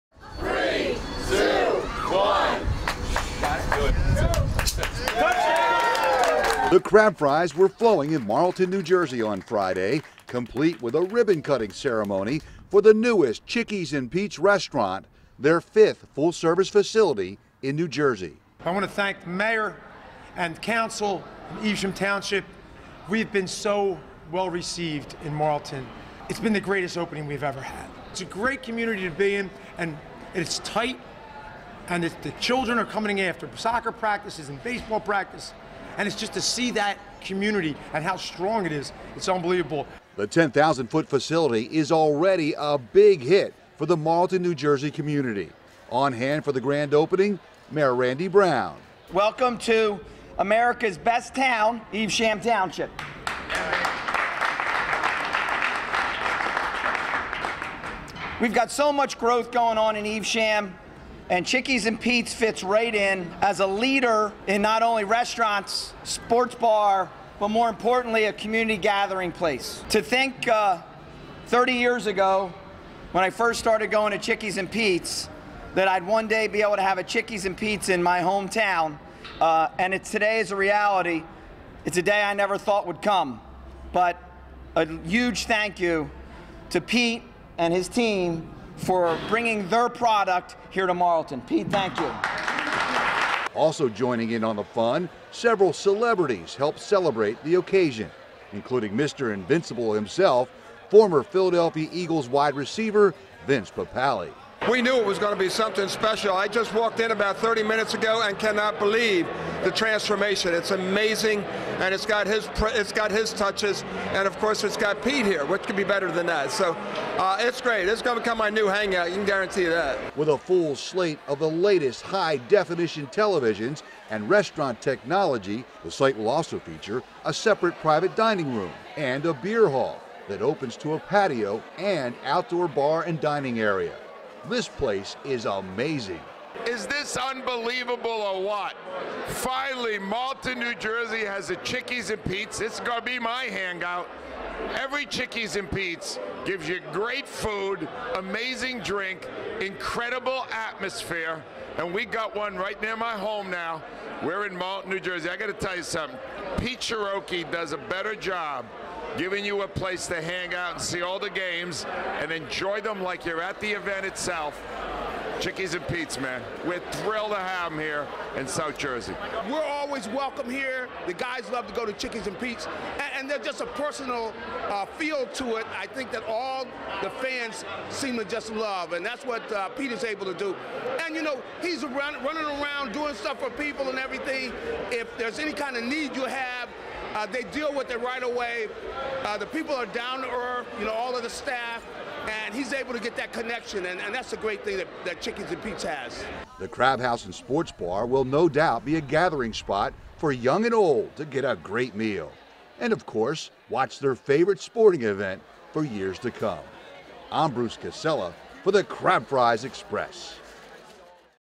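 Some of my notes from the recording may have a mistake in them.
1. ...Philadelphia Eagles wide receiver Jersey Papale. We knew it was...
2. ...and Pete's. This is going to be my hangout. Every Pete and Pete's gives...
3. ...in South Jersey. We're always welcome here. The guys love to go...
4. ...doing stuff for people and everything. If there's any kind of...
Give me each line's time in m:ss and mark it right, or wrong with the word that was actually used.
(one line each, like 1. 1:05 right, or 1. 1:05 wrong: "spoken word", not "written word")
1. 1:41 wrong: "Vince", not "Jersey"
2. 2:22 wrong: "Chickies", not "Pete"
3. 2:48 right
4. 3:02 right.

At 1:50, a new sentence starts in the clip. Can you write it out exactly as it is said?
It's amazing, and it's got his it's got his touches, and of course it's got Pete here.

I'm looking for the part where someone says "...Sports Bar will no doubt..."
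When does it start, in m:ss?
3:17.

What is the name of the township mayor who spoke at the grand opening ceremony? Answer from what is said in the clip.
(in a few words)
Randy Brown.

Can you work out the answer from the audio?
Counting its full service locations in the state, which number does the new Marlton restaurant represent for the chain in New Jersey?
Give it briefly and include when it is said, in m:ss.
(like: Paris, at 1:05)
5th, at 0:15.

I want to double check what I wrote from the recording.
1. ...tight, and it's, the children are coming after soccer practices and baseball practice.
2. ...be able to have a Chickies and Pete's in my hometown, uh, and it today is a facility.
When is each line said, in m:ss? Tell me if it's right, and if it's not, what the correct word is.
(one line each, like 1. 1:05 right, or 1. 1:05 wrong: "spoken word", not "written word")
1. 0:30 right
2. 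1:16 wrong: "reality", not "facility".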